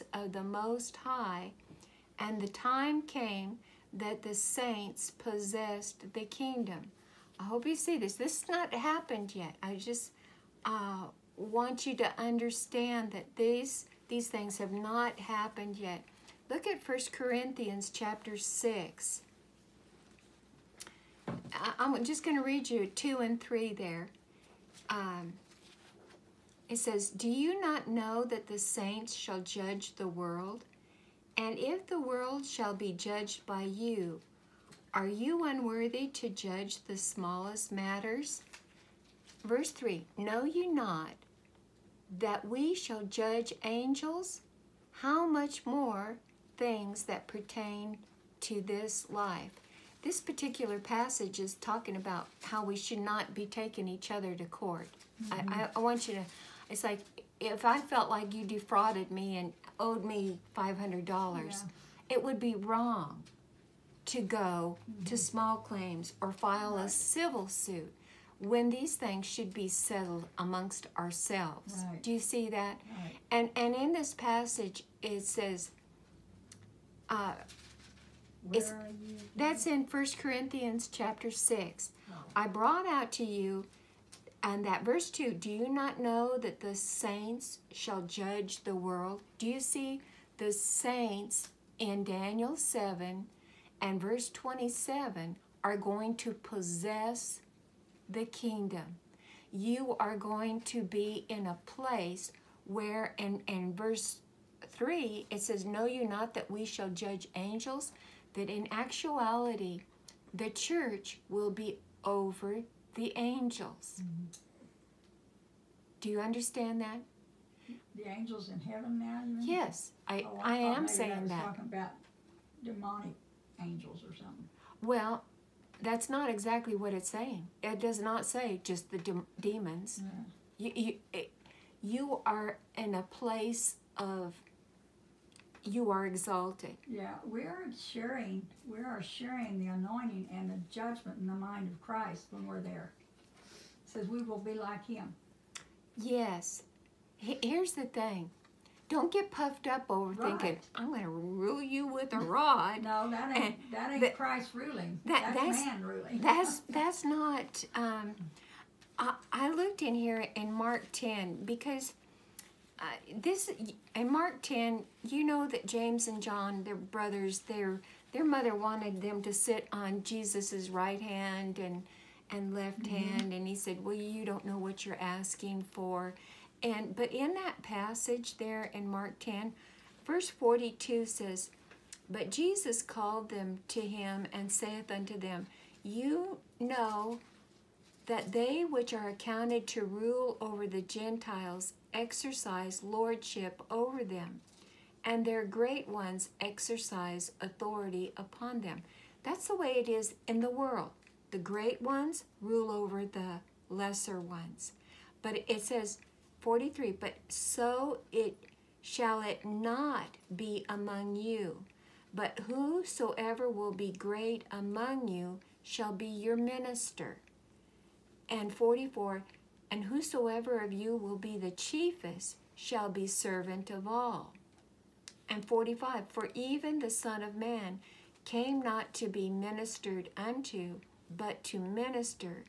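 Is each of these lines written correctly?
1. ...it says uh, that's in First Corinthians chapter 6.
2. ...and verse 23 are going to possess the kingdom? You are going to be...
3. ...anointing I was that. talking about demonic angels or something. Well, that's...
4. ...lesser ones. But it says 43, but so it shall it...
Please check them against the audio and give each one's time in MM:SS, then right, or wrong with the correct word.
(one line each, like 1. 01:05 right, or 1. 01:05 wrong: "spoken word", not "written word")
1. 01:15 right
2. 01:33 wrong: "27", not "23"
3. 02:00 wrong: "saying", not "anointing"
4. 03:23 right.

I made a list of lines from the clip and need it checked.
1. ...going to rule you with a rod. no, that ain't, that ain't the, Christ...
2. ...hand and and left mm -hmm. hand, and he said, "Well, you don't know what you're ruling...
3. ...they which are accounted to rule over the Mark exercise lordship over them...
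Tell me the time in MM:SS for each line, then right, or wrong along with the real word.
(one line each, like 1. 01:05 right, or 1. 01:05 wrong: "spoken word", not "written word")
1. 02:30 right
2. 02:51 wrong: "asking", not "ruling"
3. 03:08 wrong: "Gentiles", not "Mark".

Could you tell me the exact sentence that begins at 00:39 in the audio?
Verse 3 Know you not that we shall judge angels?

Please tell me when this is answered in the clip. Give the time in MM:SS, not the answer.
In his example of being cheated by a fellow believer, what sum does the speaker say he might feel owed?
01:00.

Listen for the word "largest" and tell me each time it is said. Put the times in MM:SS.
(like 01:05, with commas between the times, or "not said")
not said.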